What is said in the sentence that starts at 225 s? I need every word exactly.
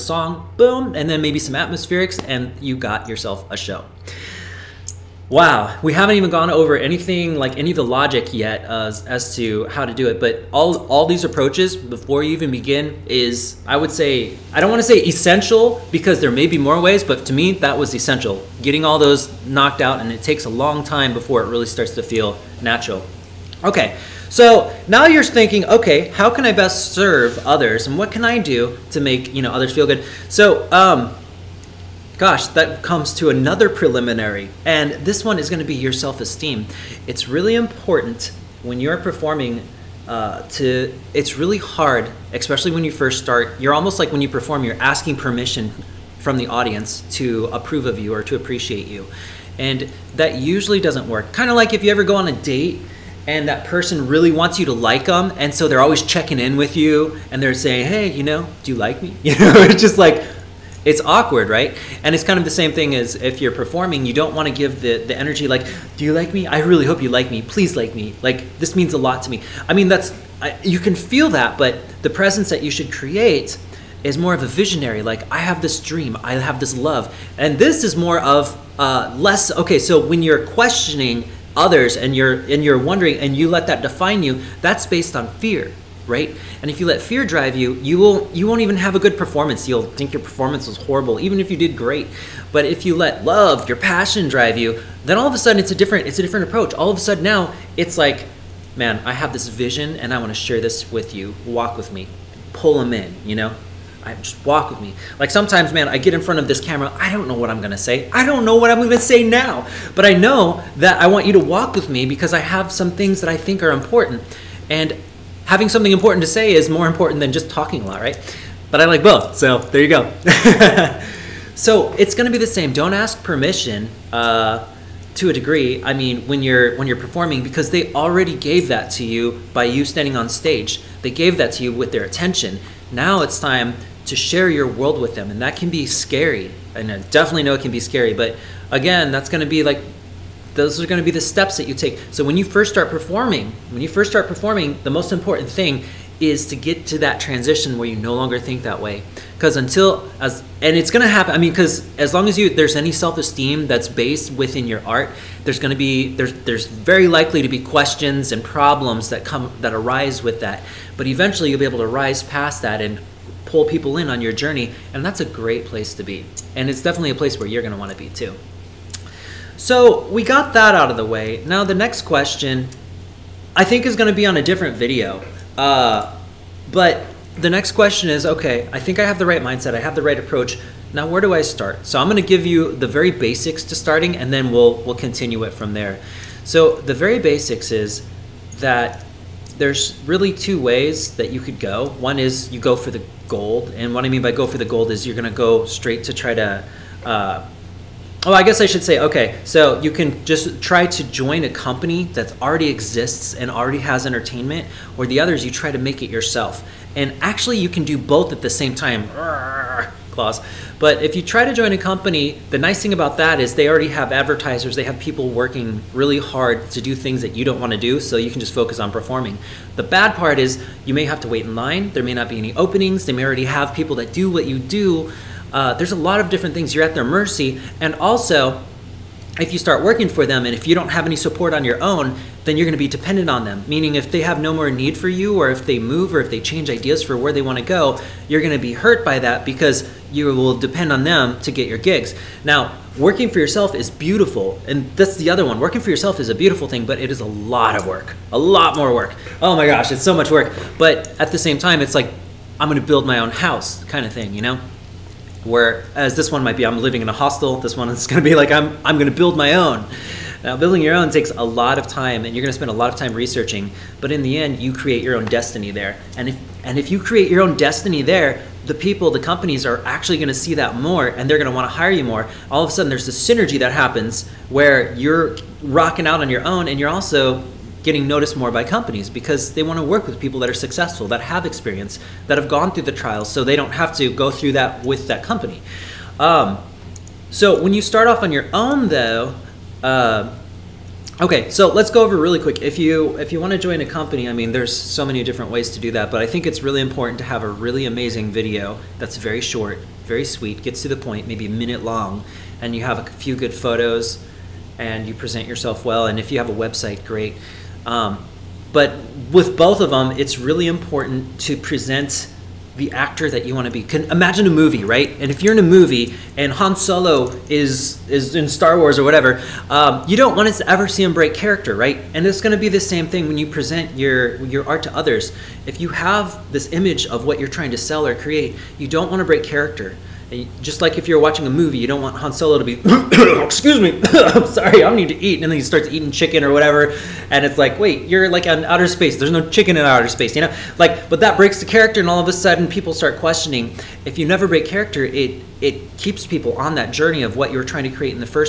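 Uh, there's a lot of different things.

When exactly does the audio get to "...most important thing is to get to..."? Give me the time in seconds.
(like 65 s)
144 s.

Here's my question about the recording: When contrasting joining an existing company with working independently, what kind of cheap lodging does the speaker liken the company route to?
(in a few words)
a hostel.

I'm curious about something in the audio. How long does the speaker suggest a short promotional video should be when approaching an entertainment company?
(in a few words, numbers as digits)
1 minute.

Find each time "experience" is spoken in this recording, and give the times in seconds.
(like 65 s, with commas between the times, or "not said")
281 s.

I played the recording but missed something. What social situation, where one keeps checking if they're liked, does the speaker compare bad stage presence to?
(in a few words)
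a date.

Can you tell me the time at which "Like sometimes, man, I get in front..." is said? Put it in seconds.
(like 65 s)
105 s.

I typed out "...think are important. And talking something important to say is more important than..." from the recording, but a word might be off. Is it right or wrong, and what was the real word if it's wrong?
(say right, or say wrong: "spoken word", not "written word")
wrong: "having", not "talking".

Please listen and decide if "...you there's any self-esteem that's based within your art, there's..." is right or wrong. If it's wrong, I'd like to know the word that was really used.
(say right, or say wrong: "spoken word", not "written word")
right.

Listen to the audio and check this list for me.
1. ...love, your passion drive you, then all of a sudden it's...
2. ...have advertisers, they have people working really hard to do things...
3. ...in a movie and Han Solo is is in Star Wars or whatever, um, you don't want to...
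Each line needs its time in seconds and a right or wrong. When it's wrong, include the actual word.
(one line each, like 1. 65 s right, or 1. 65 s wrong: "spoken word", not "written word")
1. 93 s right
2. 213 s right
3. 315 s right.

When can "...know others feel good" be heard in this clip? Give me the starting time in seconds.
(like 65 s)
29 s.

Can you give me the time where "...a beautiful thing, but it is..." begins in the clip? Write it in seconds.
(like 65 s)
246 s.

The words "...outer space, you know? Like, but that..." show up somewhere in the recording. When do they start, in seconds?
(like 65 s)
339 s.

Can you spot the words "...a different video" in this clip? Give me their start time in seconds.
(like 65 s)
174 s.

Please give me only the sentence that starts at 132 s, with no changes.
Now it's time to share your world with them, and that can be scary.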